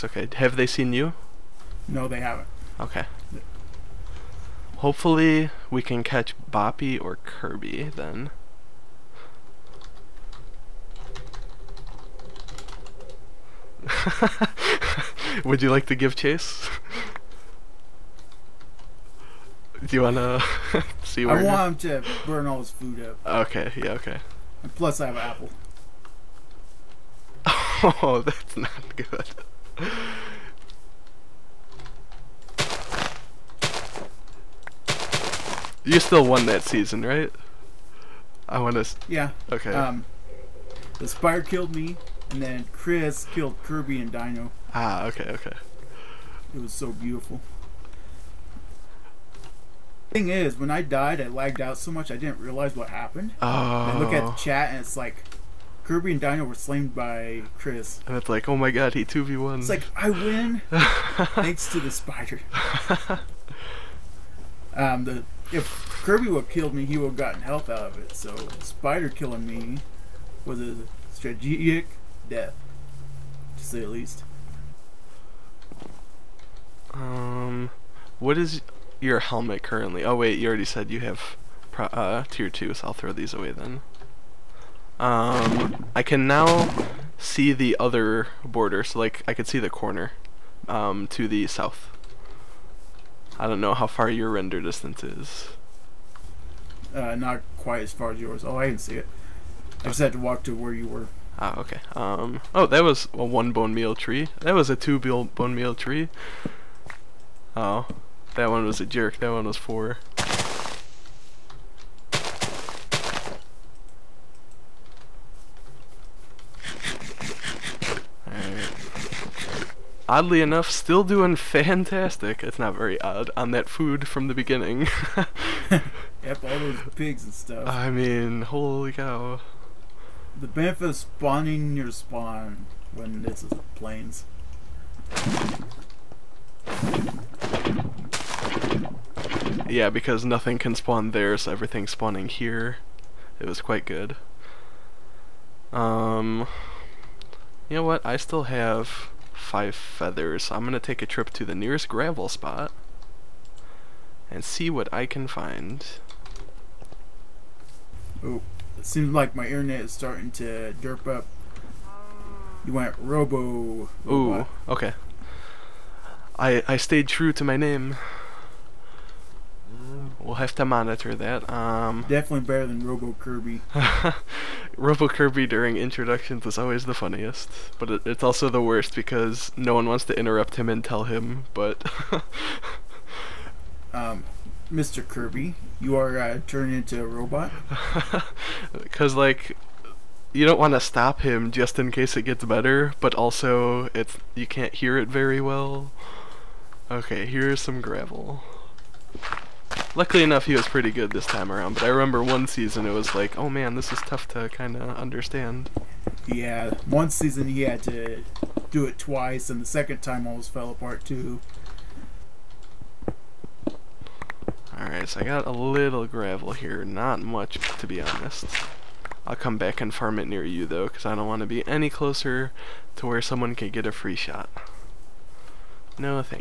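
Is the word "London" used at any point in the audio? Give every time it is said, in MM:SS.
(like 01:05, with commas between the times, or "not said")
not said.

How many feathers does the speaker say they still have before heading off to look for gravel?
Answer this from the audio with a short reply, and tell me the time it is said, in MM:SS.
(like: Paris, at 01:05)
5, at 02:29.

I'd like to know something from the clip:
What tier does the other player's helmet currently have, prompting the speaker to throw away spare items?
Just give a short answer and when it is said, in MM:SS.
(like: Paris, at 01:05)
2, at 01:22.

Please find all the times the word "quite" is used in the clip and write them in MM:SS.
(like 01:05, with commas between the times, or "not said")
01:37, 02:23.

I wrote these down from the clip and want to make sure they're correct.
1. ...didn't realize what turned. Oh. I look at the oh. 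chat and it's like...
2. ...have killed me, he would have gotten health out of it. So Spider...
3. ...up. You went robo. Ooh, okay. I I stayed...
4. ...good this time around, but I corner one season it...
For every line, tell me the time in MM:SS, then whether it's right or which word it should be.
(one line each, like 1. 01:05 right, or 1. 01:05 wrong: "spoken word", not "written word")
1. 00:52 wrong: "happened", not "turned"
2. 01:06 right
3. 02:41 right
4. 03:20 wrong: "remember", not "corner".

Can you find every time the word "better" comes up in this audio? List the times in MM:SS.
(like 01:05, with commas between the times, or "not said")
02:52, 03:12.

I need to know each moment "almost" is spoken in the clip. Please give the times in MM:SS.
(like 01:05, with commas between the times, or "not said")
03:30.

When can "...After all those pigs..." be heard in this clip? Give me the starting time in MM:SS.
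02:05.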